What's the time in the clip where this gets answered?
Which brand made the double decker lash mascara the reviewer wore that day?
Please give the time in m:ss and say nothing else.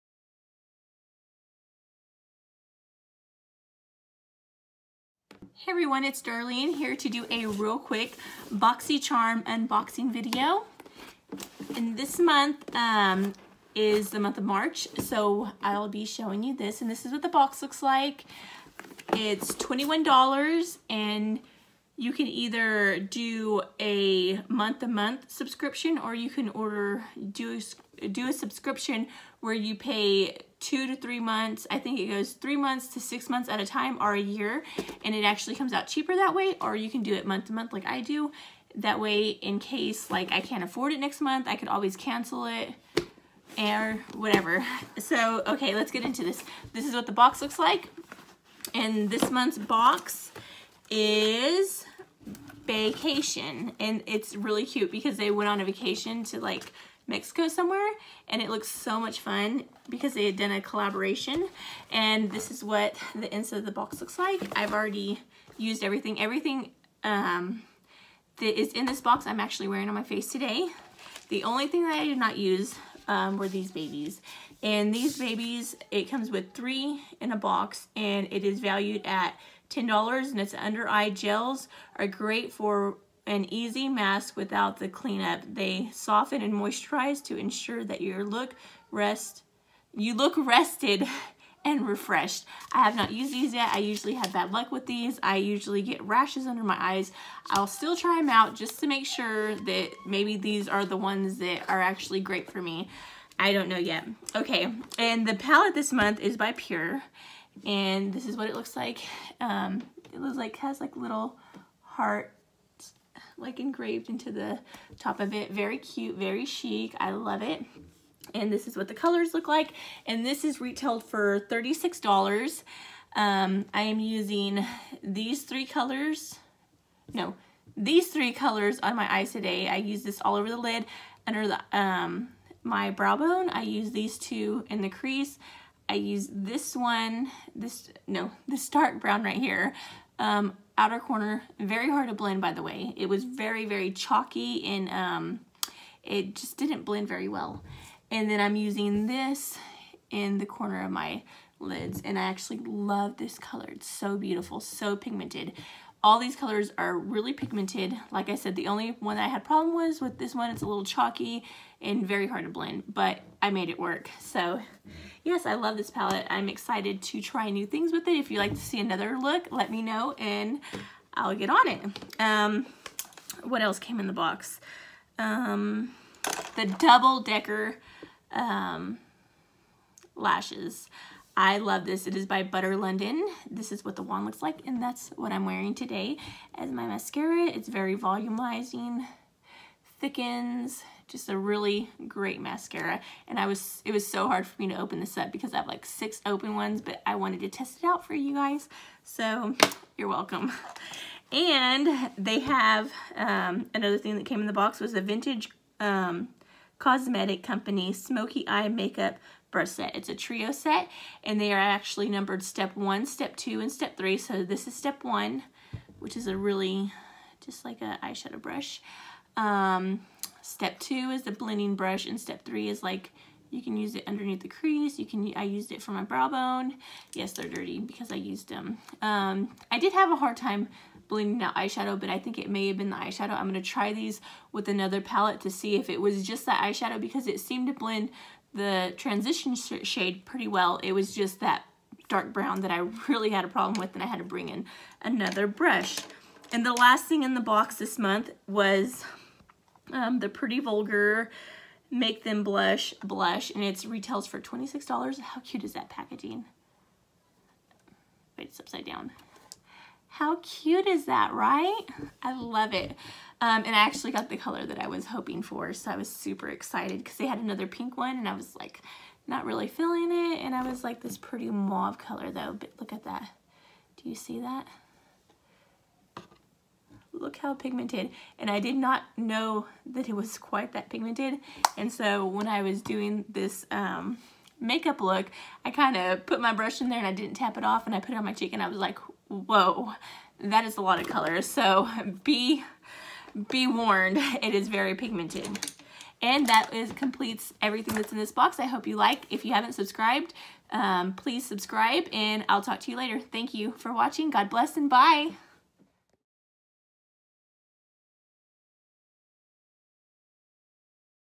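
3:02.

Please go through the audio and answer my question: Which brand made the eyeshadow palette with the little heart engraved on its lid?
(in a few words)
PÜR.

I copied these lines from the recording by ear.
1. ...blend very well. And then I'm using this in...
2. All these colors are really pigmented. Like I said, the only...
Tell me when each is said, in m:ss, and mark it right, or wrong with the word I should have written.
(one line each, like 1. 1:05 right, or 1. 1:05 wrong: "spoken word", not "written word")
1. 2:26 right
2. 2:36 right.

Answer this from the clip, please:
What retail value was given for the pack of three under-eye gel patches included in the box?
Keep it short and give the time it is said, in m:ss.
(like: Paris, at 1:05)
$10, at 1:19.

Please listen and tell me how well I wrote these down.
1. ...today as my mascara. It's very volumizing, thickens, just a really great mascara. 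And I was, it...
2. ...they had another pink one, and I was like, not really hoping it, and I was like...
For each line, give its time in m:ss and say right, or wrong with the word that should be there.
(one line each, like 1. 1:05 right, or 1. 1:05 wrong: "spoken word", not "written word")
1. 3:05 right
2. 4:27 wrong: "feeling", not "hoping".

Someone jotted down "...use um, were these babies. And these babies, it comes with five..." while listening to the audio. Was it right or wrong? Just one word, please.
wrong.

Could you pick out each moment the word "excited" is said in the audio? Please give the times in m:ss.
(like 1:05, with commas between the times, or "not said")
2:46, 4:26.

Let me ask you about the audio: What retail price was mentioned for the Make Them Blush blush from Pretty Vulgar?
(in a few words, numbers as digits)
$26.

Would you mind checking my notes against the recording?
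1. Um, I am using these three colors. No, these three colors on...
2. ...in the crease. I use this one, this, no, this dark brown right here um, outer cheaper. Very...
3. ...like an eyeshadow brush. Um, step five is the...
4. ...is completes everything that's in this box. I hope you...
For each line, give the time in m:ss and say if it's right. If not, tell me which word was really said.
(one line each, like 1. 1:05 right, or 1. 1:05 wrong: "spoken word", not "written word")
1. 2:03 right
2. 2:14 wrong: "corner", not "cheaper"
3. 3:37 wrong: "two", not "five"
4. 4:56 right.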